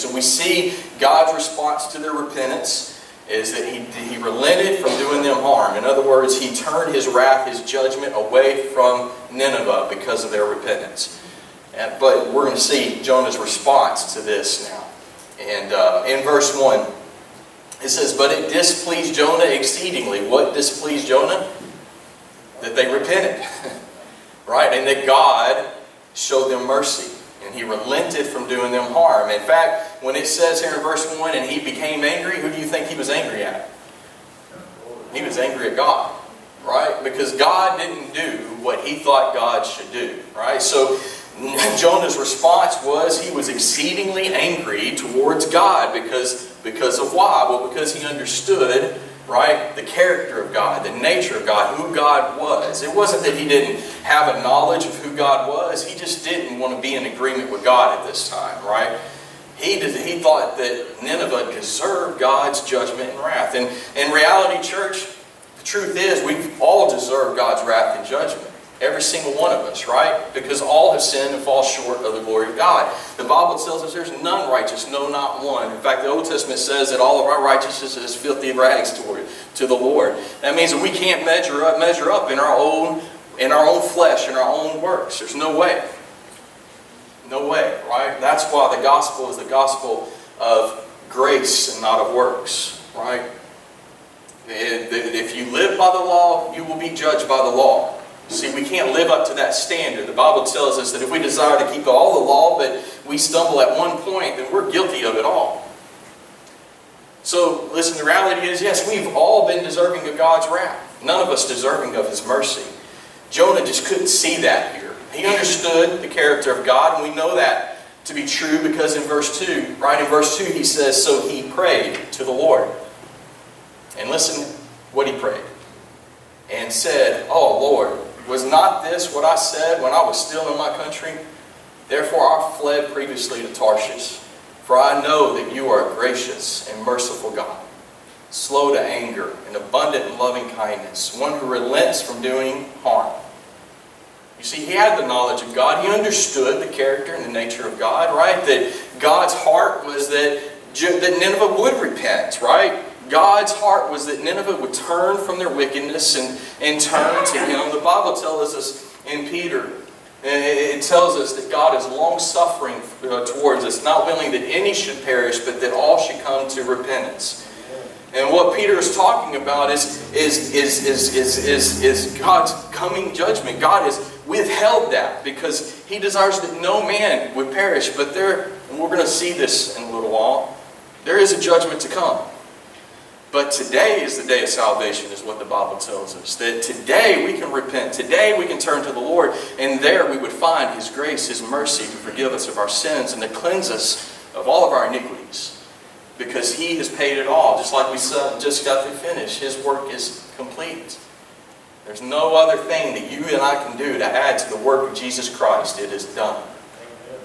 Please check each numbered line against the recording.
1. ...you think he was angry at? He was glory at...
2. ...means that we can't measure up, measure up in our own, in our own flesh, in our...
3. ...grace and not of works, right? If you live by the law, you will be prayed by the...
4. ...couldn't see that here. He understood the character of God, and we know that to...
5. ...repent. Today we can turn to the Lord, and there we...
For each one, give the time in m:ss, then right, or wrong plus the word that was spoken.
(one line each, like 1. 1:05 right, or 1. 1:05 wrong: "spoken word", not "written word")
1. 0:32 wrong: "angry", not "glory"
2. 1:20 right
3. 1:31 wrong: "judged", not "prayed"
4. 1:53 right
5. 3:07 right.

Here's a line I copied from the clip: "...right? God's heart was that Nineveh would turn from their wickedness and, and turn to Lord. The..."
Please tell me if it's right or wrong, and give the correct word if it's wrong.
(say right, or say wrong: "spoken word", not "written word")
wrong: "Him", not "Lord".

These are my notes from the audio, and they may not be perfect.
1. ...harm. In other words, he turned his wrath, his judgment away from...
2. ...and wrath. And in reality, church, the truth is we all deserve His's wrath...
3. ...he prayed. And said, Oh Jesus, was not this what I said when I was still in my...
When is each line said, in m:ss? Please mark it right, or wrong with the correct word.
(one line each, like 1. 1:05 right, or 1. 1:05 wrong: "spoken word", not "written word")
1. 0:05 right
2. 1:03 wrong: "God", not "His"
3. 2:05 wrong: "Lord", not "Jesus".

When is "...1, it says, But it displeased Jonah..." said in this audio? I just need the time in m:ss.
0:16.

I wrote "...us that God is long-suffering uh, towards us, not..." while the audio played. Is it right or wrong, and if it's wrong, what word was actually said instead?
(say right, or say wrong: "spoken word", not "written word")
right.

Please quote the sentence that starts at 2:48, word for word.
And what Peter is talking about is, is, is, is, is, is, is God's coming judgment.